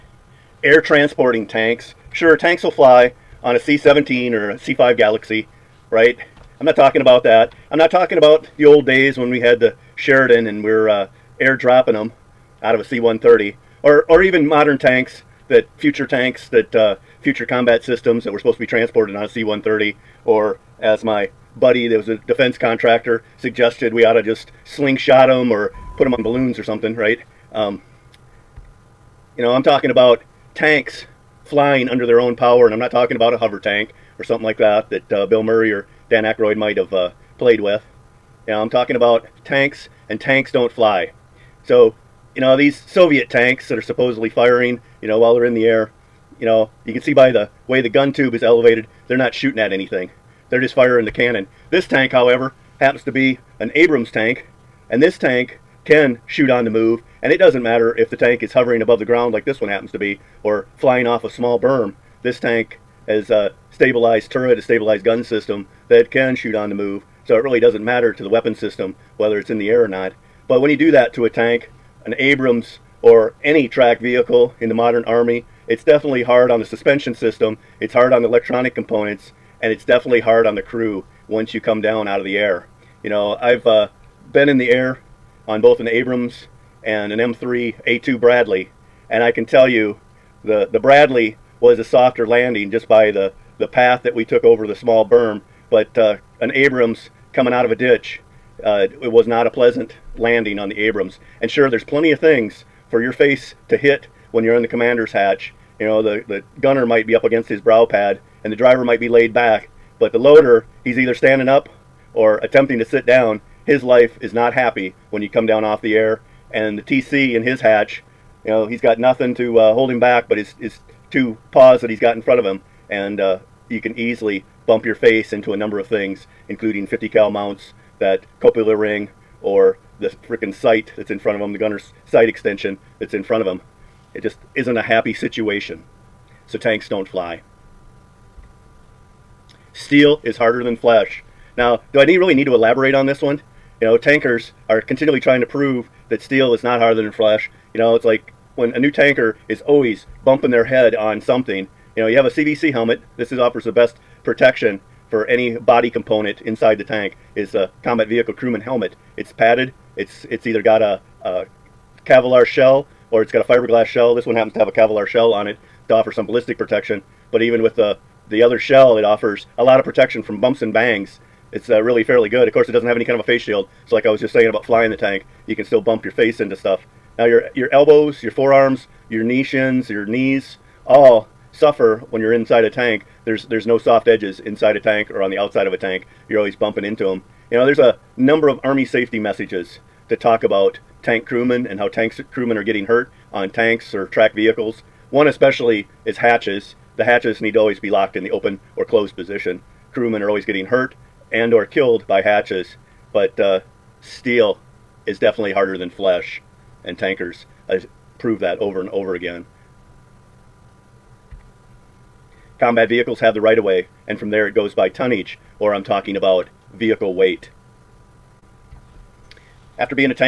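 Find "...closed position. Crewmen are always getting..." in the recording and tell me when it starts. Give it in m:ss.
3:18.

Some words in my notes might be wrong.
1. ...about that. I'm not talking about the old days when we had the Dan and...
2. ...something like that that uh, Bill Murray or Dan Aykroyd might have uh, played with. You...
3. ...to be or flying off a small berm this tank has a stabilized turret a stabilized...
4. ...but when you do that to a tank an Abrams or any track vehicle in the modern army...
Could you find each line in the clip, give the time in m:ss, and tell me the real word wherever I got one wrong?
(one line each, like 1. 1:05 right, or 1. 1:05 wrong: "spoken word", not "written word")
1. 0:07 wrong: "Sheridan", not "Dan"
2. 0:34 right
3. 0:59 right
4. 1:10 right.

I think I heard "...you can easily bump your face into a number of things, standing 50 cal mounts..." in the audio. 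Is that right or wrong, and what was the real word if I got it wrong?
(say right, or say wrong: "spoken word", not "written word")
wrong: "including", not "standing".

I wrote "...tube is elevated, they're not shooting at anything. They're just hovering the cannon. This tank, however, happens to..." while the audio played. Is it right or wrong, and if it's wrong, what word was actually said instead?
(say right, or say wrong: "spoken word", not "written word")
wrong: "firing", not "hovering".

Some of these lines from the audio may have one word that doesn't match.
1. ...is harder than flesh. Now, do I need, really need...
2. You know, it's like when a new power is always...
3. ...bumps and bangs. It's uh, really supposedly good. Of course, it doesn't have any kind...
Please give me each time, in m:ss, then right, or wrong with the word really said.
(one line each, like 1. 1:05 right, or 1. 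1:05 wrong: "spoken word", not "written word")
1. 2:20 right
2. 2:27 wrong: "tanker", not "power"
3. 2:50 wrong: "fairly", not "supposedly".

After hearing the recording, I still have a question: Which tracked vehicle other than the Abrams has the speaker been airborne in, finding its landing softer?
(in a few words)
M3 A2 Bradley.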